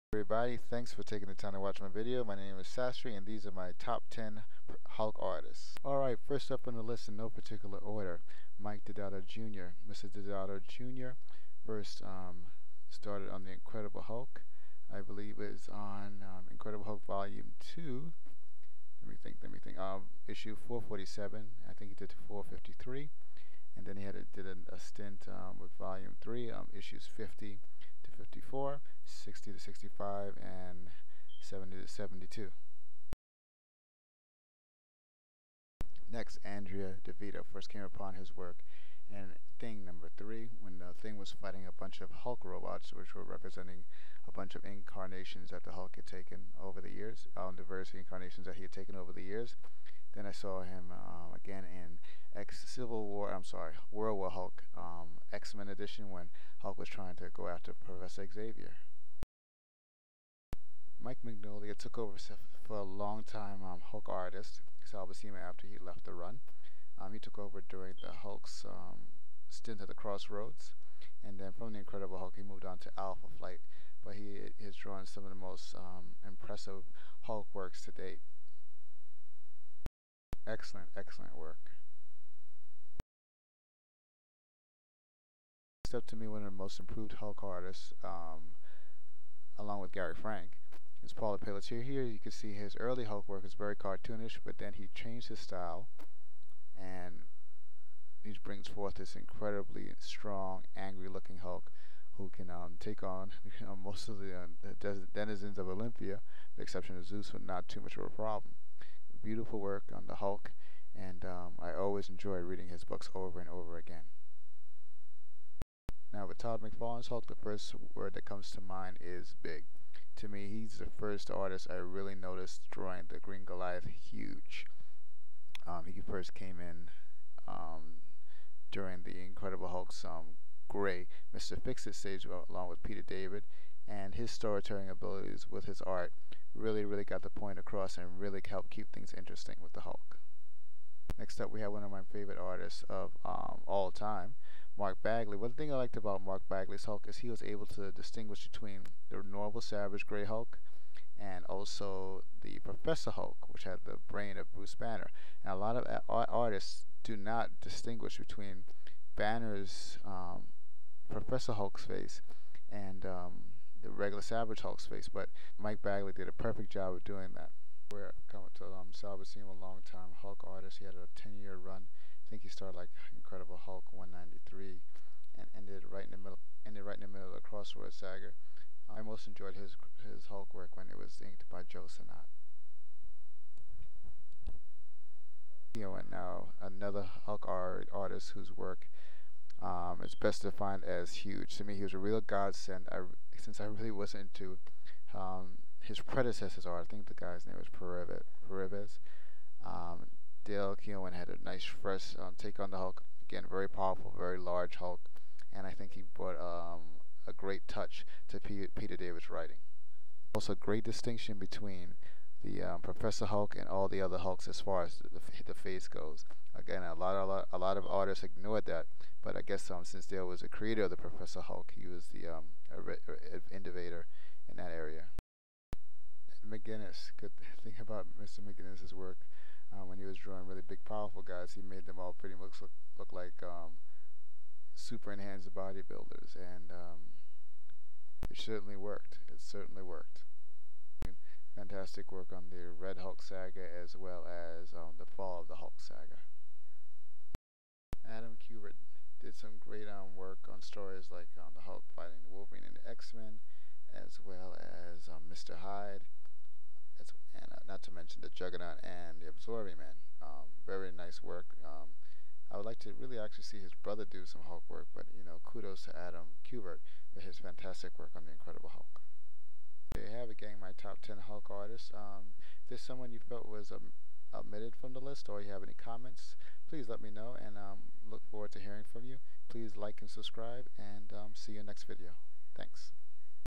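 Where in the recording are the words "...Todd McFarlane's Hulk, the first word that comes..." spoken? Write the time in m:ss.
1:56.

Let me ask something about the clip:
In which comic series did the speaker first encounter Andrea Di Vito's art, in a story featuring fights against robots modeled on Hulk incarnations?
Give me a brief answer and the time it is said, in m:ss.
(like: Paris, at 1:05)
Thing number 3, at 0:39.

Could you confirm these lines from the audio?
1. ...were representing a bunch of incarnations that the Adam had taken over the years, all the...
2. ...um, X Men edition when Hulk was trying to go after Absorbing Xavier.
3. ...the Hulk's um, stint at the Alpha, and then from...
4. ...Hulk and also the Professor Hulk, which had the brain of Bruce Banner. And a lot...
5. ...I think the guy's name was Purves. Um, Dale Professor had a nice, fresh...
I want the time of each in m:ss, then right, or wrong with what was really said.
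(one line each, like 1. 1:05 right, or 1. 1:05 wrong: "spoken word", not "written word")
1. 0:43 wrong: "Hulk", not "Adam"
2. 0:54 wrong: "Professor", not "Absorbing"
3. 1:08 wrong: "Crossroads", not "Alpha"
4. 2:30 right
5. 3:16 wrong: "Keown", not "Professor".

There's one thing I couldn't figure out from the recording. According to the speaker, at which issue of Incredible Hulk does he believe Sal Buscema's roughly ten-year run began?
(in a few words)
193.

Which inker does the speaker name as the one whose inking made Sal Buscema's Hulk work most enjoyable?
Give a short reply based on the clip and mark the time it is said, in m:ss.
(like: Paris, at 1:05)
Joe Sinnott, at 3:01.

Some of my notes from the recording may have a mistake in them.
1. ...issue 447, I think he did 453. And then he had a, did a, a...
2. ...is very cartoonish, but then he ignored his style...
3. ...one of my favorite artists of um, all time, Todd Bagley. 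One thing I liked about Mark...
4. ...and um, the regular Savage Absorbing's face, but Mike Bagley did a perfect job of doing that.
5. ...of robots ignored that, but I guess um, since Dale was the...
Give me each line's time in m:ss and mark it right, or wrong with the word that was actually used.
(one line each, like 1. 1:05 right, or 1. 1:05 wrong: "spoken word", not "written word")
1. 0:20 right
2. 1:33 wrong: "changed", not "ignored"
3. 2:21 wrong: "Mark", not "Todd"
4. 2:42 wrong: "Hulk", not "Absorbing"
5. 3:37 wrong: "artists", not "robots".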